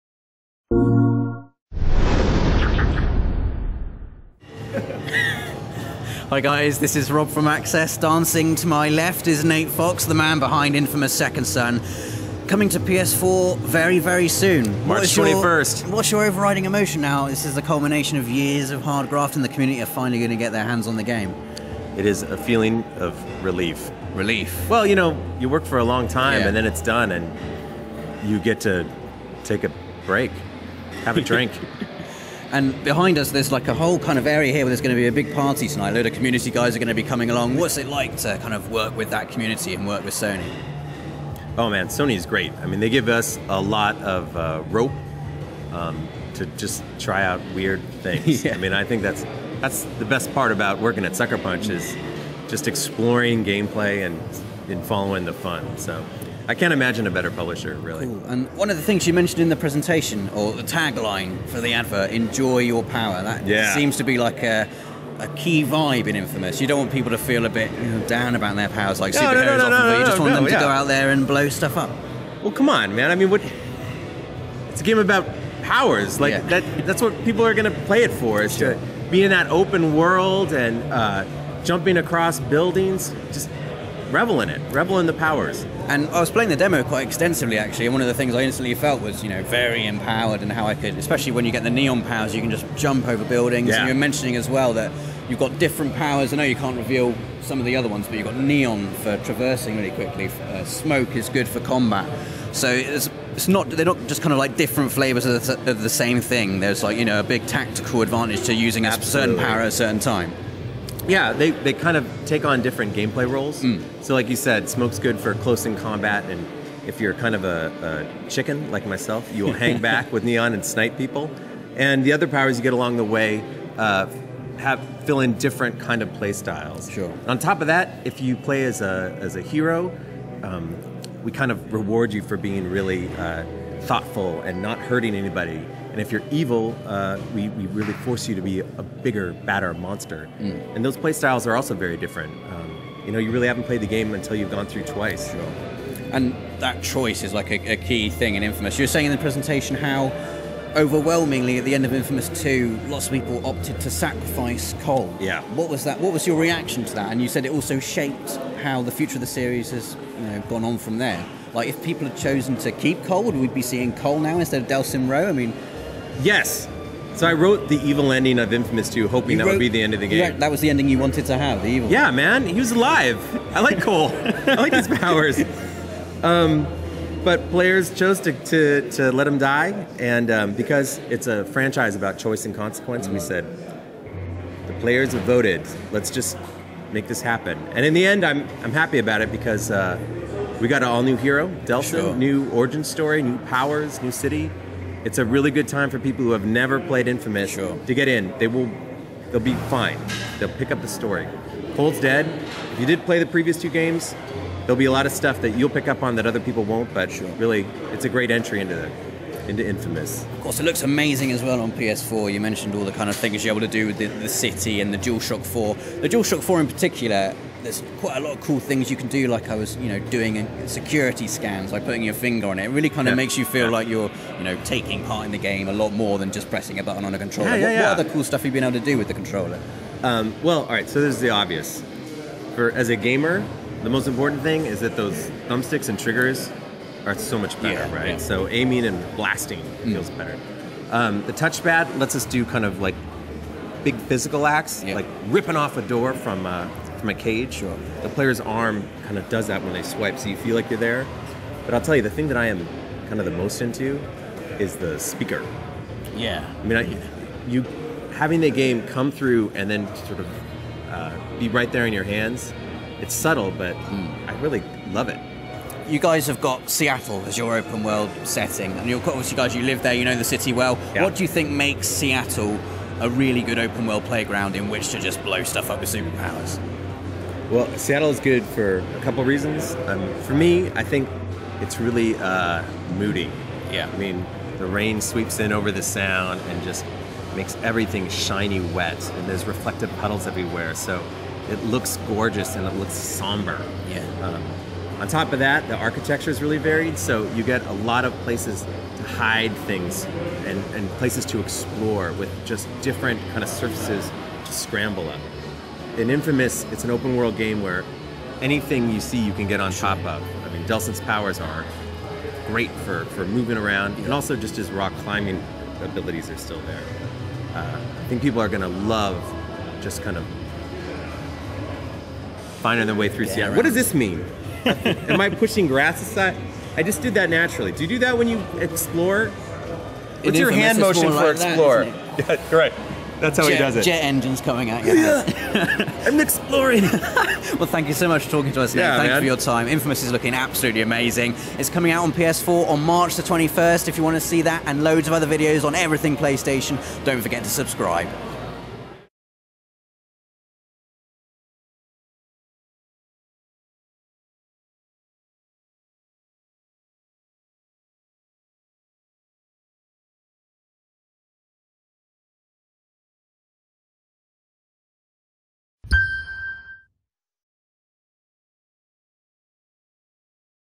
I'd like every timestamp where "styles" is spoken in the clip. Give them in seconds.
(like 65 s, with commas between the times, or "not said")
126 s, 141 s.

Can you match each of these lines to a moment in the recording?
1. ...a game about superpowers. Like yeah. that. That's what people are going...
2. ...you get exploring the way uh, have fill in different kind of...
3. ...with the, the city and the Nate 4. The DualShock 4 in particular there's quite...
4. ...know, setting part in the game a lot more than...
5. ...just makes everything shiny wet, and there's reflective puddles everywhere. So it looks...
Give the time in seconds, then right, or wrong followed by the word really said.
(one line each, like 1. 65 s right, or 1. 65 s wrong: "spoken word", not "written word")
1. 74 s wrong: "powers", not "superpowers"
2. 122 s wrong: "along", not "exploring"
3. 213 s wrong: "DualShock", not "Nate"
4. 224 s wrong: "taking", not "setting"
5. 286 s right.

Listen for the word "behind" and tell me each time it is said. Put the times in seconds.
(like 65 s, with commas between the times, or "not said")
10 s, 32 s.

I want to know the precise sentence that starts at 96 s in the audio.
I know you can't reveal some of the other ones, but you've got neon for traversing really quickly.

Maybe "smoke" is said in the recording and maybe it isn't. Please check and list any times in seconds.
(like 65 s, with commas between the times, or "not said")
100 s, 114 s.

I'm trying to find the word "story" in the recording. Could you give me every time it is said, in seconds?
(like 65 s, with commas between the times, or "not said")
192 s, 200 s.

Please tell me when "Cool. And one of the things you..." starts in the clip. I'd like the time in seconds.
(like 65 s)
58 s.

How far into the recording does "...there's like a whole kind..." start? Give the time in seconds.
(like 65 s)
33 s.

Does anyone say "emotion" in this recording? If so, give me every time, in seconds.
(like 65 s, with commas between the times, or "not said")
16 s.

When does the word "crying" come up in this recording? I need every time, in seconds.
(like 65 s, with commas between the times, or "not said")
not said.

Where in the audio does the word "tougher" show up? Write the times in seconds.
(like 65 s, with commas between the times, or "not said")
not said.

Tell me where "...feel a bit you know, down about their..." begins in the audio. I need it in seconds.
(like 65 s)
67 s.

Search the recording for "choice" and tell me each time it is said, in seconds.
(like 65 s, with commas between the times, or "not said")
146 s, 182 s.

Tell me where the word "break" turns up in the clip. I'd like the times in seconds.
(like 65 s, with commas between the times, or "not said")
30 s.